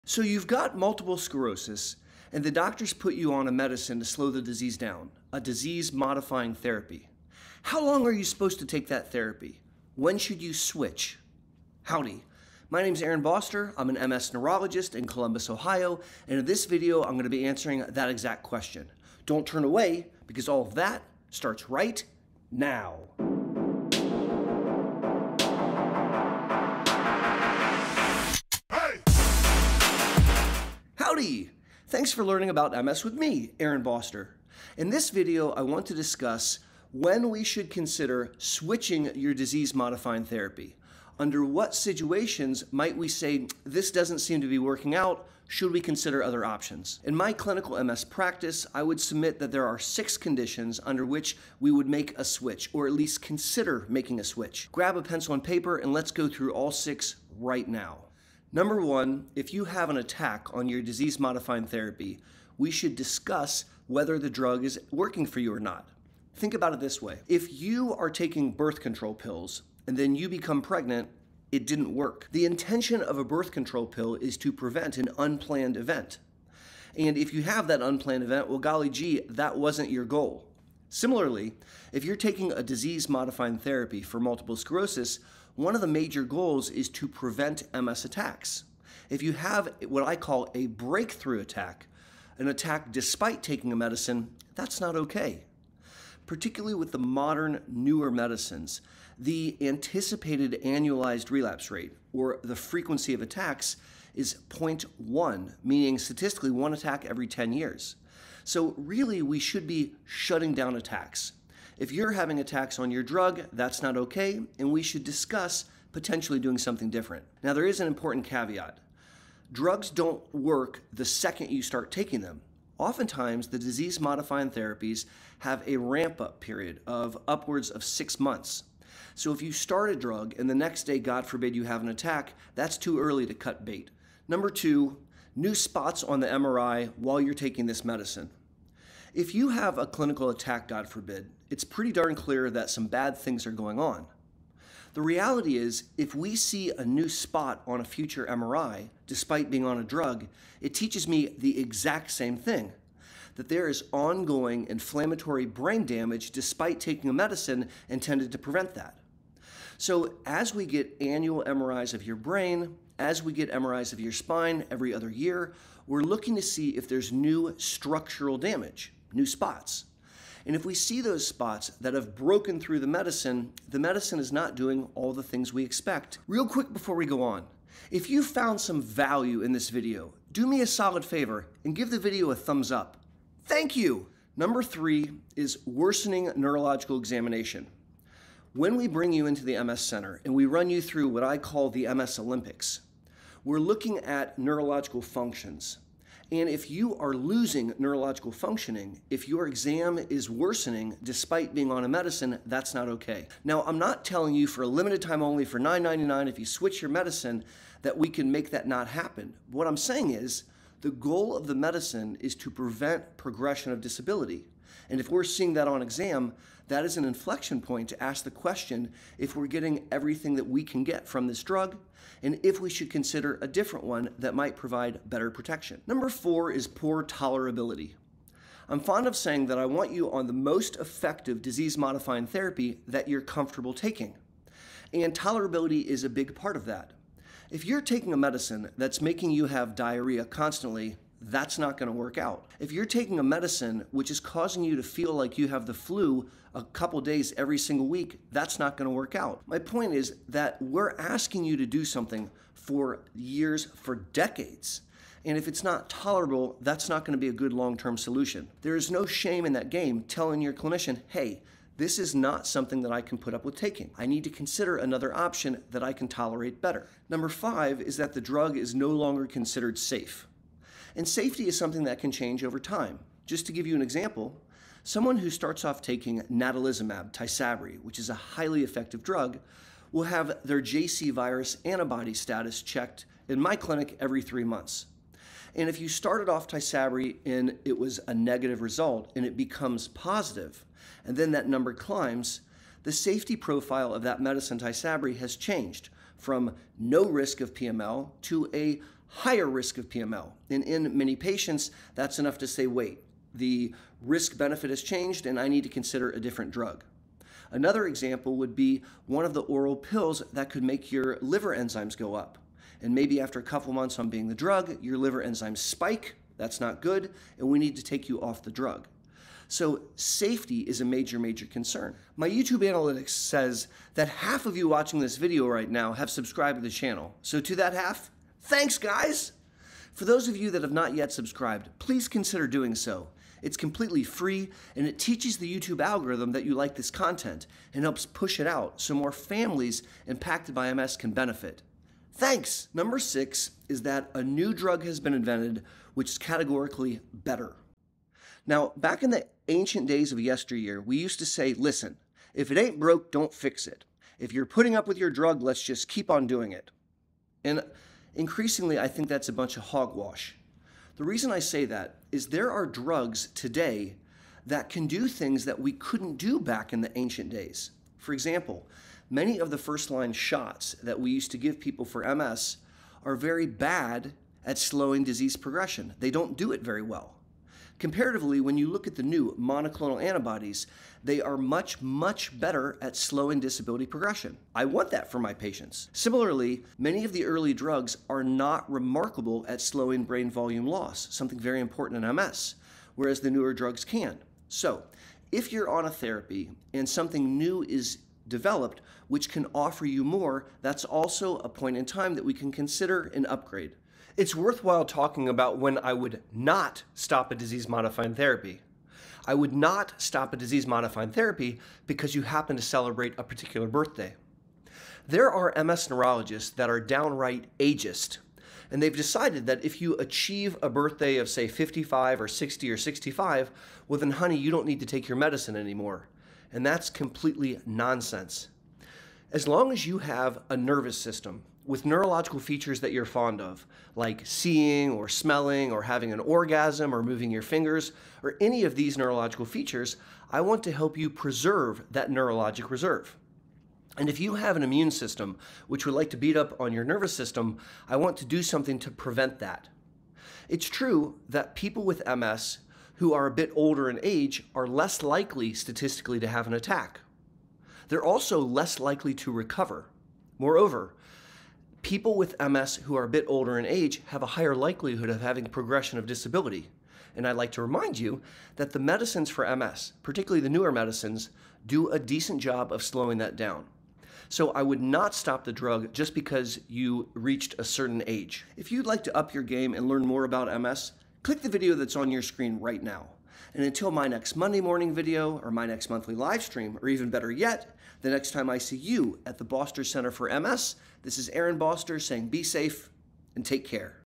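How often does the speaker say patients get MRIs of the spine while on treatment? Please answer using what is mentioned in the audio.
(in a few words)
every other year.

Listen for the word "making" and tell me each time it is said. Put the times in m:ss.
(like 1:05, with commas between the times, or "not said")
0:53, 3:59.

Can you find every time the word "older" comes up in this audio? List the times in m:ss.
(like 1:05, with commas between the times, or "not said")
7:33, 7:43.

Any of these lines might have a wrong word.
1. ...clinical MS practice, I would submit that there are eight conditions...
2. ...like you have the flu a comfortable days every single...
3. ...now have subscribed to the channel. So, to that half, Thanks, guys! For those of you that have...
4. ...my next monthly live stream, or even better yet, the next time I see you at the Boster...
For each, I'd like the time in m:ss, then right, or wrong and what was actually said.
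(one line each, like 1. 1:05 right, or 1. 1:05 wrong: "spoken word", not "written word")
1. 0:47 wrong: "six", not "eight"
2. 4:05 wrong: "couple", not "comfortable"
3. 5:25 right
4. 8:05 right.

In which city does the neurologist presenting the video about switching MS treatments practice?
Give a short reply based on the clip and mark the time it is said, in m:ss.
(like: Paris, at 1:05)
Columbus, Ohio, at 0:15.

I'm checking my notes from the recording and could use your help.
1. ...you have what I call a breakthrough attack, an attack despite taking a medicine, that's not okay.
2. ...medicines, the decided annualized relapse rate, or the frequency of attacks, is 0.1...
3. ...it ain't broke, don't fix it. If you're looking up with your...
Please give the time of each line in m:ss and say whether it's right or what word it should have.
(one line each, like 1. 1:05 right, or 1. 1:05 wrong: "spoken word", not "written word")
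1. 1:29 right
2. 1:38 wrong: "anticipated", not "decided"
3. 5:52 wrong: "putting", not "looking".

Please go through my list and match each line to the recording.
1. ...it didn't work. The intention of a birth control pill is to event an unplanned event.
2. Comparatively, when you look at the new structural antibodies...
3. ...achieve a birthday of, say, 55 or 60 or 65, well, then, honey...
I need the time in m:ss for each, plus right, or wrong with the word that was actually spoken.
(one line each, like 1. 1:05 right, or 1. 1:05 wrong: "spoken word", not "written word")
1. 1:11 wrong: "prevent", not "event"
2. 6:17 wrong: "monoclonal", not "structural"
3. 6:59 right.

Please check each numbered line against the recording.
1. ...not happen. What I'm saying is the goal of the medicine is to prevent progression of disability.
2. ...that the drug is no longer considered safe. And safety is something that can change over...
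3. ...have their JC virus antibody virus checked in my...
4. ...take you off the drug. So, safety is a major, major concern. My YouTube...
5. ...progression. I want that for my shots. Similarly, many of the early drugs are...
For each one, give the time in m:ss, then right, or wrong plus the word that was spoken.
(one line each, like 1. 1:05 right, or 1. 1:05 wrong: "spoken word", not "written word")
1. 3:28 right
2. 4:27 right
3. 4:40 wrong: "status", not "virus"
4. 5:17 right
5. 6:23 wrong: "patients", not "shots".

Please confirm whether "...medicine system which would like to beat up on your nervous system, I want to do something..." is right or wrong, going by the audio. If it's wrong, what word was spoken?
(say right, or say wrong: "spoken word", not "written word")
wrong: "immune", not "medicine".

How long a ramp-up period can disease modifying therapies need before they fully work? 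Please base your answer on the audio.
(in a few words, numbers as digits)
6 months.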